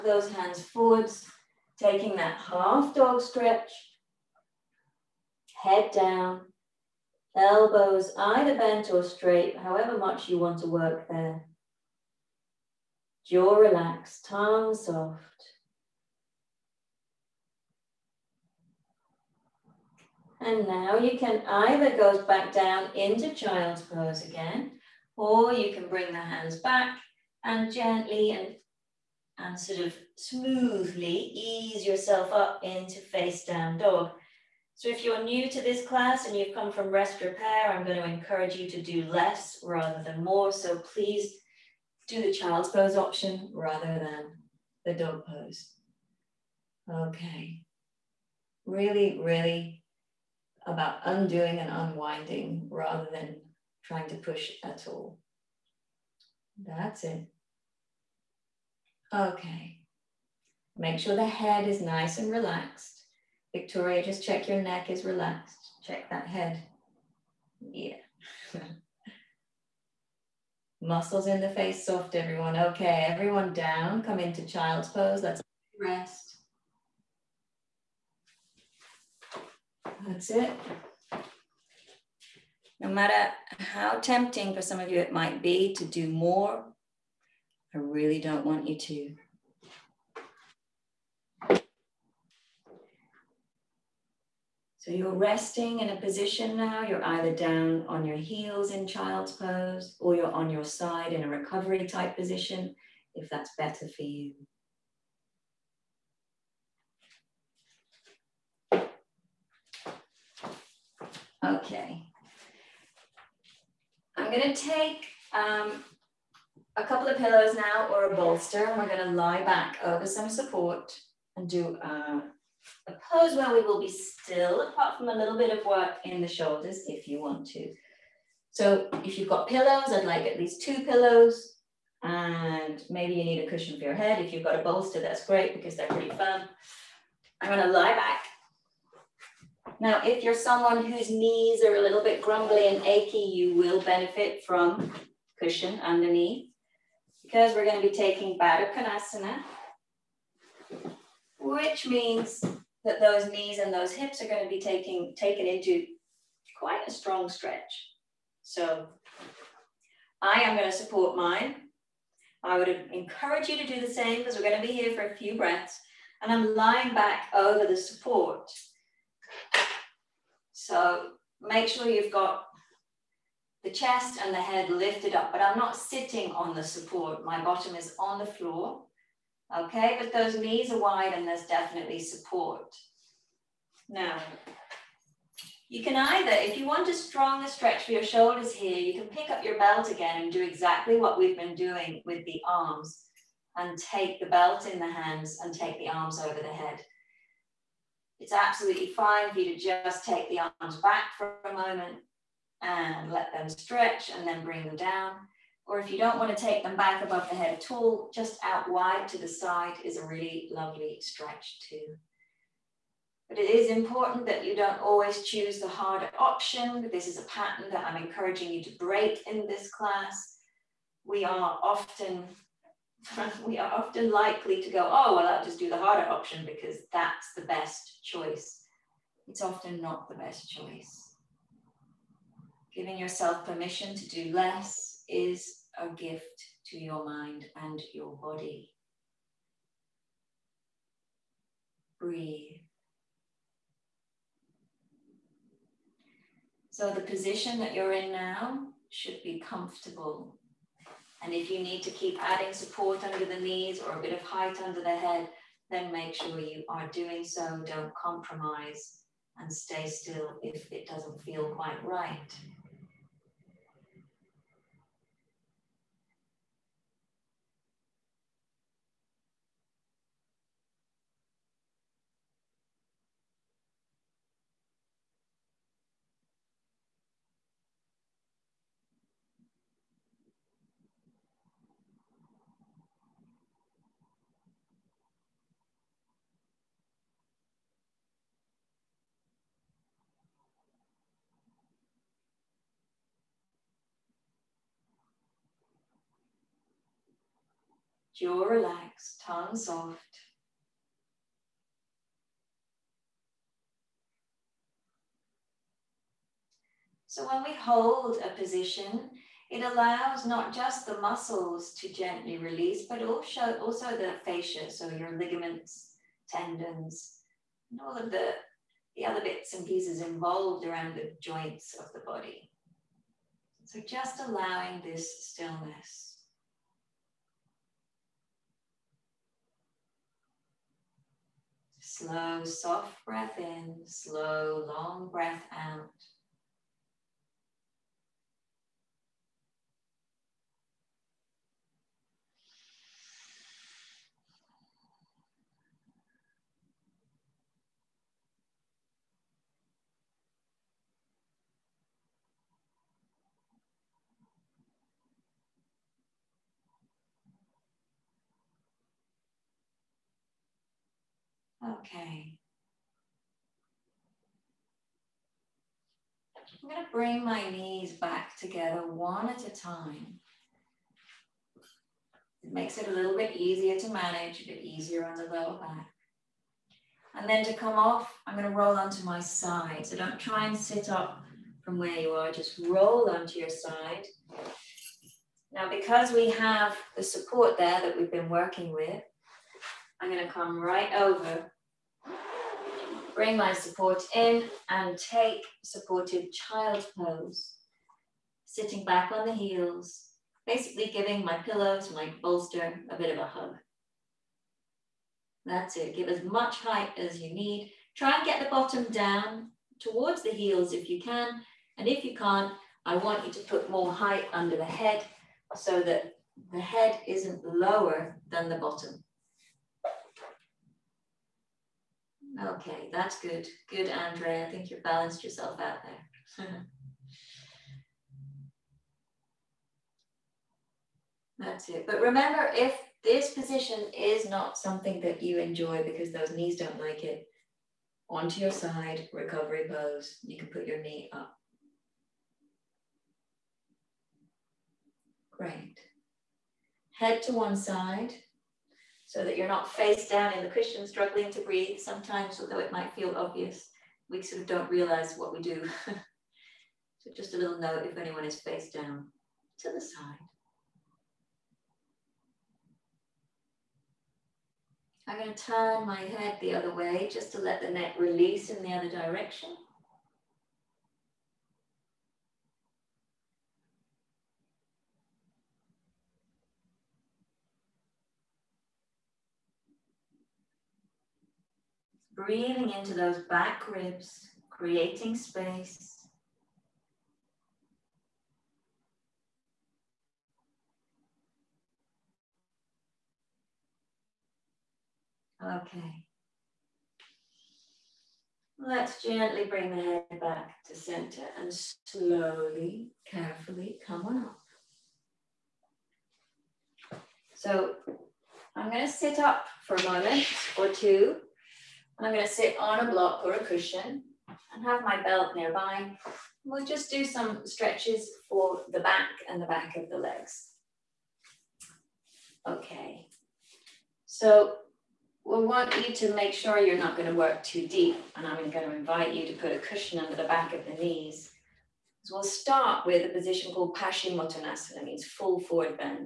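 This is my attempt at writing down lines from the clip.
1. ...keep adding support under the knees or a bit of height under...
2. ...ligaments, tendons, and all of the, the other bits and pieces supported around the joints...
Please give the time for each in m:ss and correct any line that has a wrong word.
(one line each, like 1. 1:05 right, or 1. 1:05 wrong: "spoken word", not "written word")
1. 4:11 right
2. 5:15 wrong: "involved", not "supported".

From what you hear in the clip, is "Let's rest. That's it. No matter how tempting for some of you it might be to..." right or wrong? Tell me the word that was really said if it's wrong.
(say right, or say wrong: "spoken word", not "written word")
right.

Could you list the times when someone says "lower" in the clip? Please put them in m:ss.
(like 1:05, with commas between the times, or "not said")
6:15, 6:57.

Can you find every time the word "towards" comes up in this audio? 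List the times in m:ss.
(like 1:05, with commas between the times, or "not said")
6:49.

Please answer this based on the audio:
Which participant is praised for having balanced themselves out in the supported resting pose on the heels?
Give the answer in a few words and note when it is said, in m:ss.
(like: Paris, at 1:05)
Andre, at 7:03.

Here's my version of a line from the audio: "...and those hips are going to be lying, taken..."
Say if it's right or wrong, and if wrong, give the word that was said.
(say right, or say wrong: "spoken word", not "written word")
wrong: "taking", not "lying".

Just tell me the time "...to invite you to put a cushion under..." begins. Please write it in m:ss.
8:48.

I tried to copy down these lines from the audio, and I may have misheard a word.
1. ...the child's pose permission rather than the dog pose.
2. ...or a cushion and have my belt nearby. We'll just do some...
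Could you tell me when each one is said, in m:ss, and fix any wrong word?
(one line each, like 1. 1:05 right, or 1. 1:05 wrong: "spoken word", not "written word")
1. 0:42 wrong: "option", not "permission"
2. 8:33 right.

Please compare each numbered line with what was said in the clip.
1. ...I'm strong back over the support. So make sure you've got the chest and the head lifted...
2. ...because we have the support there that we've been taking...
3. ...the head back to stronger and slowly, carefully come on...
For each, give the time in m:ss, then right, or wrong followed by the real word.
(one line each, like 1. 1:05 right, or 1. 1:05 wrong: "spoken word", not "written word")
1. 2:46 wrong: "lying", not "strong"
2. 6:25 wrong: "working", not "taking"
3. 8:19 wrong: "center", not "stronger".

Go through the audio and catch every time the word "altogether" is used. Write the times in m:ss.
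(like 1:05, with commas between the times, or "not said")
not said.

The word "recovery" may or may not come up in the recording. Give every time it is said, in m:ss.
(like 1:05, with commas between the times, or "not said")
1:41, 7:19.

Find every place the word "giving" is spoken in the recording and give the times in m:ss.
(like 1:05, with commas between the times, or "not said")
3:52, 6:40.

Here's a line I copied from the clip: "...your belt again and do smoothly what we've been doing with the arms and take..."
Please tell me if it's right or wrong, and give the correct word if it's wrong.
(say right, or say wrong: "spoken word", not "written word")
wrong: "exactly", not "smoothly".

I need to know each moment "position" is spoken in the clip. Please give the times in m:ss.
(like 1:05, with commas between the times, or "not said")
1:36, 1:42, 4:07, 5:08, 7:13, 8:53.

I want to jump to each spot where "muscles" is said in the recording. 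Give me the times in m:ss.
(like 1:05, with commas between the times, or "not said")
1:10, 5:11.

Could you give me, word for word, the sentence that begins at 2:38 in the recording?
So I am going to support mine.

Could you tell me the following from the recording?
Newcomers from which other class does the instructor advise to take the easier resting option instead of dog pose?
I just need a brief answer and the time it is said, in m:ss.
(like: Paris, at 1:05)
Rest repair, at 0:36.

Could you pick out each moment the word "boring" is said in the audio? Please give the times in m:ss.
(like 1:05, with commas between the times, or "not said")
not said.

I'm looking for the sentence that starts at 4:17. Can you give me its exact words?
Don't compromise and stay still if it doesn't feel quite right.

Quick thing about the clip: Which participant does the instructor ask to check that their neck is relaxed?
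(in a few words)
Victoria.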